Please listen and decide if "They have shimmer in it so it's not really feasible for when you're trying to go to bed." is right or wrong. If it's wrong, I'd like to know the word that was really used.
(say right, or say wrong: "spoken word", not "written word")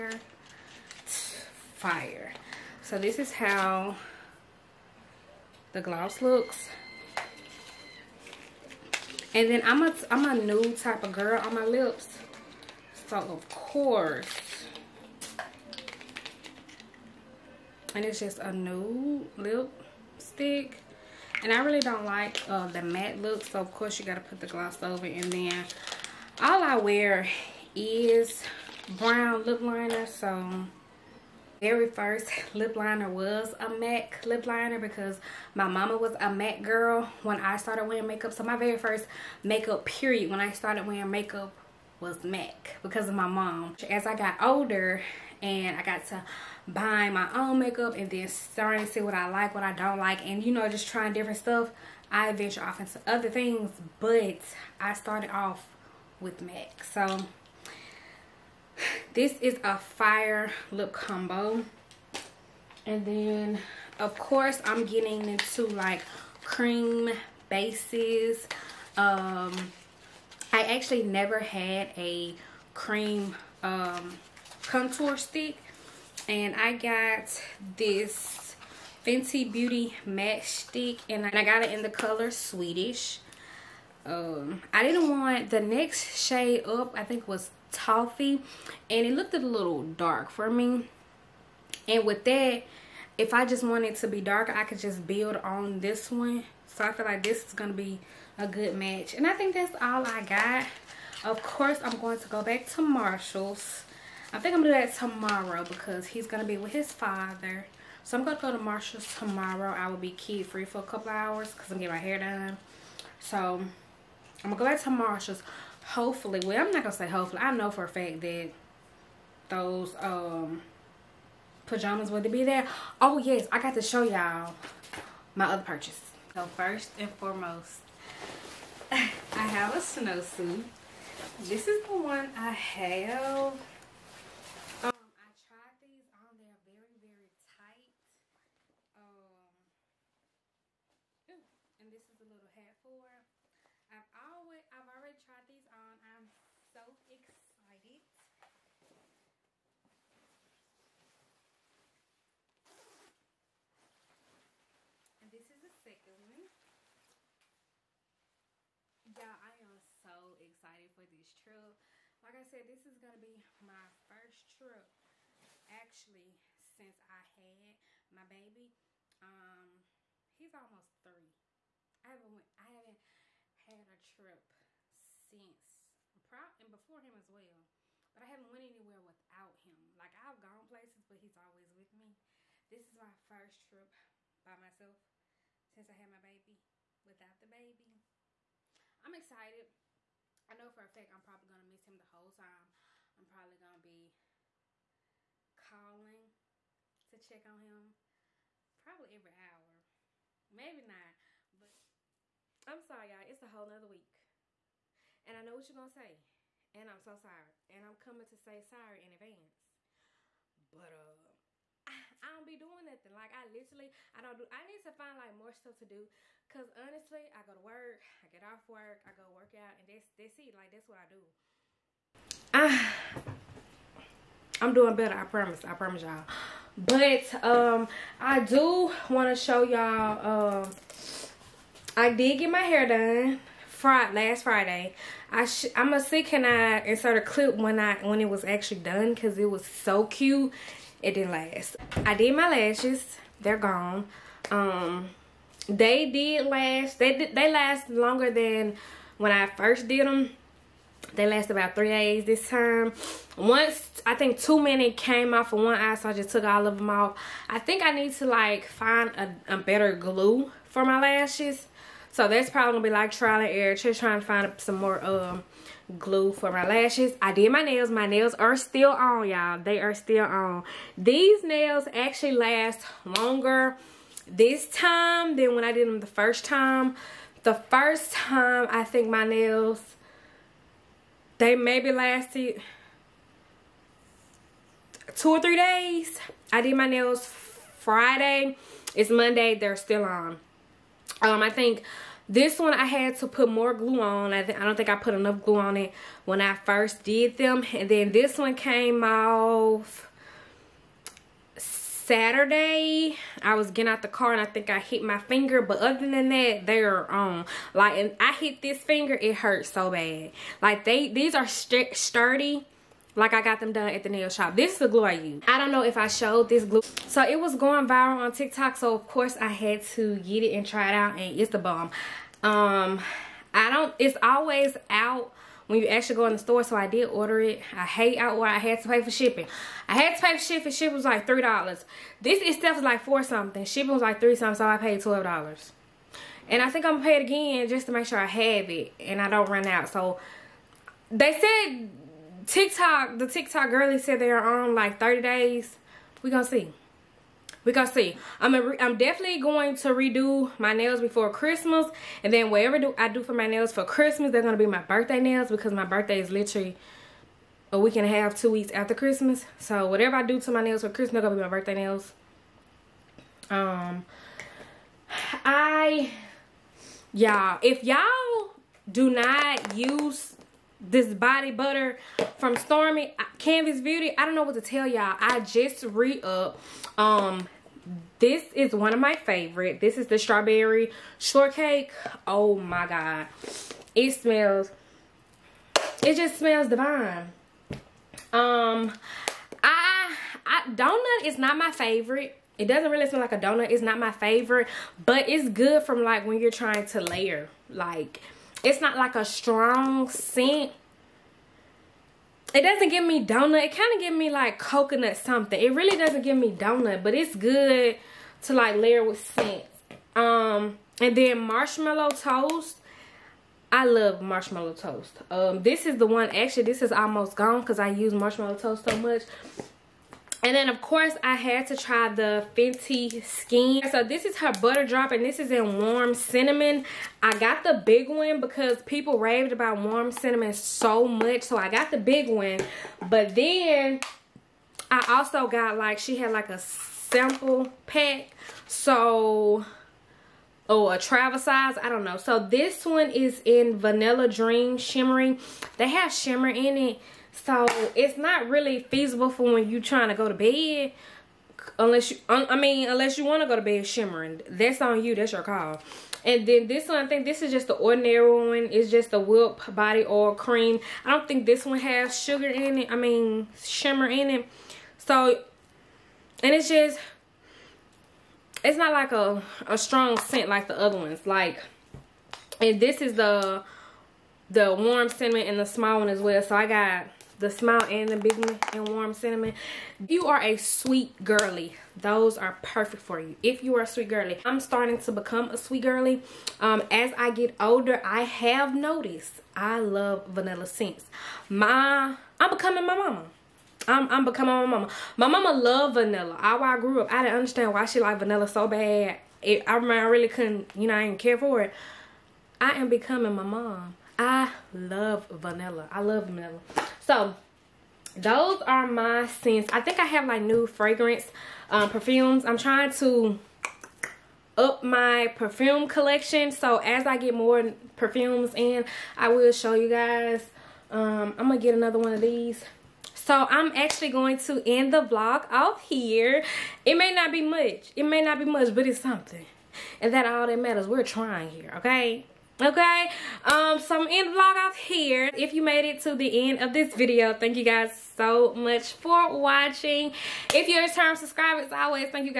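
right.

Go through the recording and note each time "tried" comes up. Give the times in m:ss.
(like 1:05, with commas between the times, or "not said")
2:15, 2:25.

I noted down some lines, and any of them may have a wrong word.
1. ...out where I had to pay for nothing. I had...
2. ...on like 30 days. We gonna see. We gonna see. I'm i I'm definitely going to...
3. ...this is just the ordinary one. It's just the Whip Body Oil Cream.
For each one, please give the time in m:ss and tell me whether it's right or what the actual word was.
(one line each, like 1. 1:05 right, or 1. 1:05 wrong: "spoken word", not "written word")
1. 5:28 wrong: "shipping", not "nothing"
2. 5:44 right
3. 7:37 right.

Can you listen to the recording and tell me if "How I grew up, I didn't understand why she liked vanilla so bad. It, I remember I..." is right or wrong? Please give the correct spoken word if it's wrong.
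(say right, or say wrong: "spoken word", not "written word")
right.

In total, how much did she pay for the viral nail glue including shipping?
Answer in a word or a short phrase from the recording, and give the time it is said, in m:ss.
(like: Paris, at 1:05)
$12, at 5:35.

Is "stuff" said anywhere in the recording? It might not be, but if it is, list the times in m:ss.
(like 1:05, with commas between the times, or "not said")
0:51, 3:35.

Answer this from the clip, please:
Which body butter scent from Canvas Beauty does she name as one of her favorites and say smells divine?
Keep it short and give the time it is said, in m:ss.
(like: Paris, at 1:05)
Strawberry shortcake, at 6:20.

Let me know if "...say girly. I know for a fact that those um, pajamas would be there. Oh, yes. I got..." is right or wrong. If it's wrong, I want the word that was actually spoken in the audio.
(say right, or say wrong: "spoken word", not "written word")
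wrong: "hopefully", not "girly".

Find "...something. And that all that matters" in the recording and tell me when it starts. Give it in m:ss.
8:48.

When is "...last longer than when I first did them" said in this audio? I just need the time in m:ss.
4:07.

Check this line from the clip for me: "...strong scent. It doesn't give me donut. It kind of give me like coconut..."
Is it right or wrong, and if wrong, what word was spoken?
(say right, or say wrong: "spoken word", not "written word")
right.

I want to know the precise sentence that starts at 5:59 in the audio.
So whatever I do to my nails for Christmas, they're gonna be my birthday nails.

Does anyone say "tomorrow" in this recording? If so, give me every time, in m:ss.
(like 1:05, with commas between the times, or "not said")
1:44, 1:49.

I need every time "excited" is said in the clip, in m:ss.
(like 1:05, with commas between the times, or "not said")
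2:27, 2:40, 3:09.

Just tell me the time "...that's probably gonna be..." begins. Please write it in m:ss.
4:22.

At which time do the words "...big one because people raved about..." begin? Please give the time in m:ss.
7:07.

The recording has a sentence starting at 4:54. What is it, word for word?
I, I don't think I put enough glue on it when I first did them.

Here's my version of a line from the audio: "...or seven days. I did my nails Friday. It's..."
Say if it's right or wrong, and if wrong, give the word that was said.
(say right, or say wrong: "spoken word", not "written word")
wrong: "three", not "seven".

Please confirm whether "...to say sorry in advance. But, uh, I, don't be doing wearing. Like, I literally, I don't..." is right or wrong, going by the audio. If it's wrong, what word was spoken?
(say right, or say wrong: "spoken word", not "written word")
wrong: "nothing", not "wearing".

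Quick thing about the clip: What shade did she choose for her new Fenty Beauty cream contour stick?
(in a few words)
Swedish.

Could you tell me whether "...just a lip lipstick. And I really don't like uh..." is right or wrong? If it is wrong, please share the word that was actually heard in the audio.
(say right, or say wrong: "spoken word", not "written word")
right.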